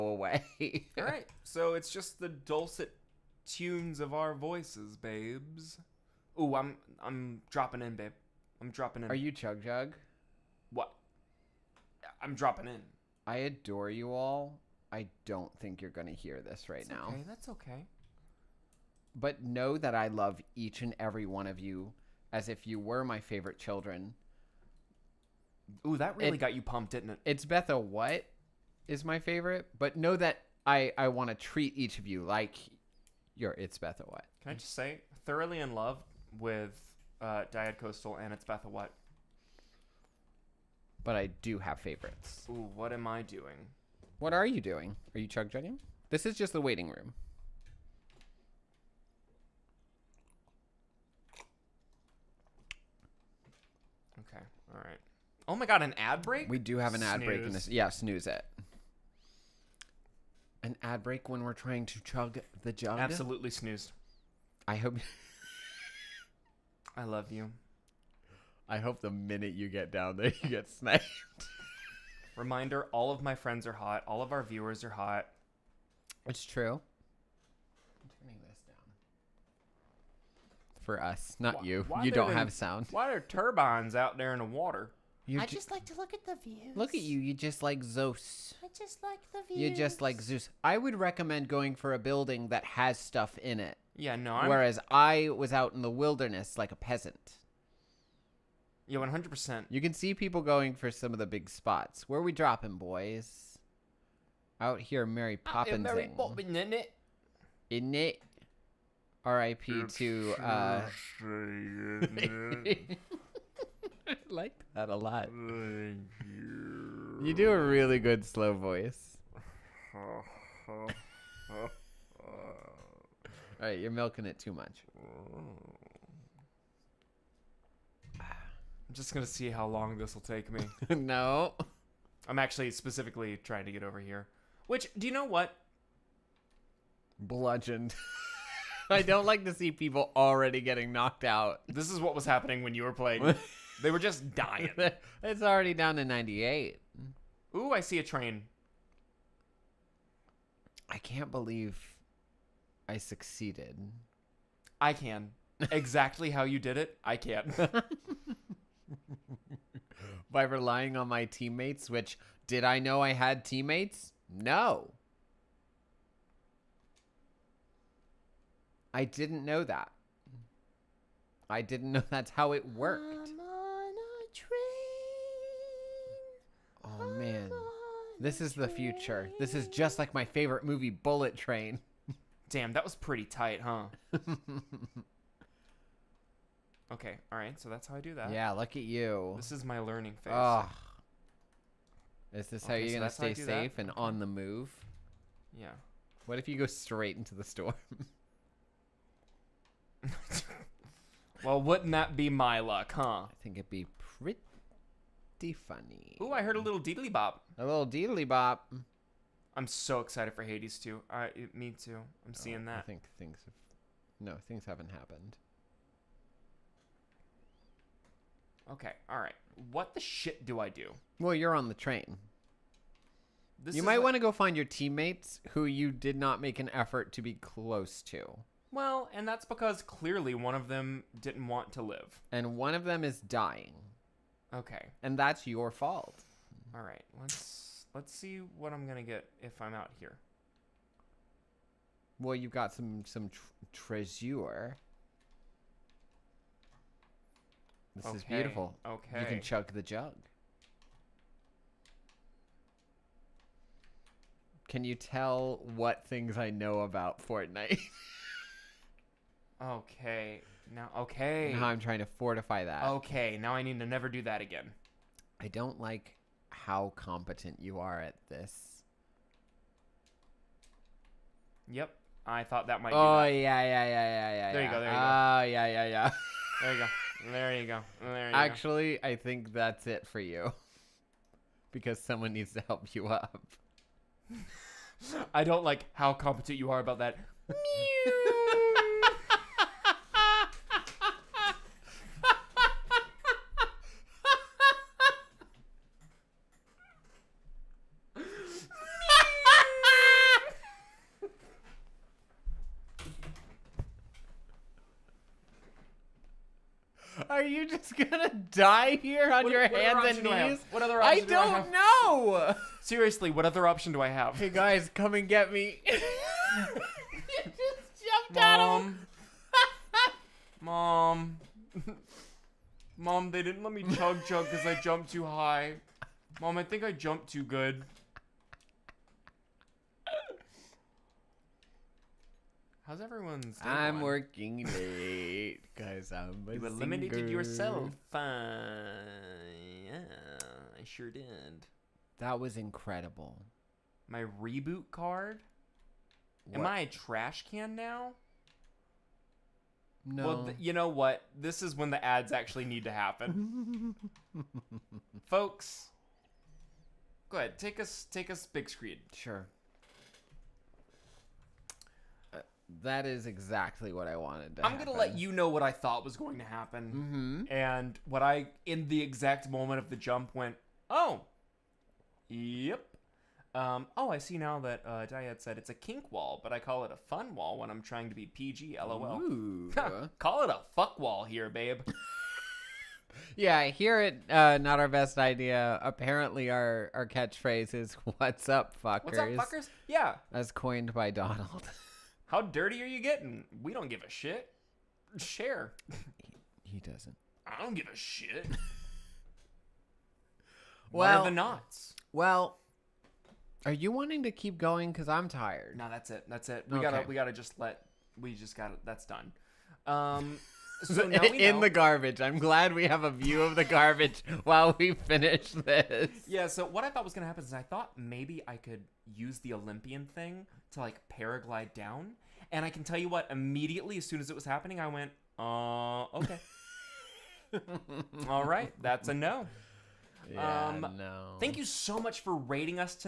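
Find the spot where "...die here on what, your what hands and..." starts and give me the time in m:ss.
5:08.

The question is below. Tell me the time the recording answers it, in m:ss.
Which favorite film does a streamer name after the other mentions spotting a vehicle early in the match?
3:00.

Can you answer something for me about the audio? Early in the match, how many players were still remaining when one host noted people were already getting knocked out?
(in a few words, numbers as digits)
98.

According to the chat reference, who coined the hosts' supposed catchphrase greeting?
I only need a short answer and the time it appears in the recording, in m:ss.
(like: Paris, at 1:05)
Donald, at 6:31.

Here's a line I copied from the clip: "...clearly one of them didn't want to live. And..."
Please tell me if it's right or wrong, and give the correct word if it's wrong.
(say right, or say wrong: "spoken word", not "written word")
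right.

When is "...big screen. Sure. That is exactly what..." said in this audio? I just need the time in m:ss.
5:58.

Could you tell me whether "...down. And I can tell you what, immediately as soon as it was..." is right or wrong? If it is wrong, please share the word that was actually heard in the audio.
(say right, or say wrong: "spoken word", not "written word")
right.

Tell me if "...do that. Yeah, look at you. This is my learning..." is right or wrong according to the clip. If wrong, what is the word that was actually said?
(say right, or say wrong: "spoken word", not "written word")
right.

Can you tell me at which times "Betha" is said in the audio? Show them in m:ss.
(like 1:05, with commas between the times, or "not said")
0:27, 0:33, 0:38.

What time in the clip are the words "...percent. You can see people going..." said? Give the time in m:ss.
1:39.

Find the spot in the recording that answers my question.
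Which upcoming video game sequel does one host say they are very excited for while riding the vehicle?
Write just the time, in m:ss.
3:30.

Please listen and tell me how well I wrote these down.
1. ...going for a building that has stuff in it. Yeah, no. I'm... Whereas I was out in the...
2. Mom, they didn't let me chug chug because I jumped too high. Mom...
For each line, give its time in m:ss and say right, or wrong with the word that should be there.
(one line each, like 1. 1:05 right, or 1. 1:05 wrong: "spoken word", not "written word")
1. 1:31 right
2. 5:22 right.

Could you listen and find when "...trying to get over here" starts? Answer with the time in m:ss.
2:13.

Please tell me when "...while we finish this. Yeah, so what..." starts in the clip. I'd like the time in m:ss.
6:54.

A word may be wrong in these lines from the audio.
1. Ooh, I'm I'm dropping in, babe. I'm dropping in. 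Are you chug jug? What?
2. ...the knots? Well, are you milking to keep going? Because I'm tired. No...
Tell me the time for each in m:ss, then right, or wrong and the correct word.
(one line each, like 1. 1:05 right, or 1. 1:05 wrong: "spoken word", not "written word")
1. 0:06 right
2. 6:41 wrong: "wanting", not "milking".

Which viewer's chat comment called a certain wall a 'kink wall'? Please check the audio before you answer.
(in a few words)
Dyad.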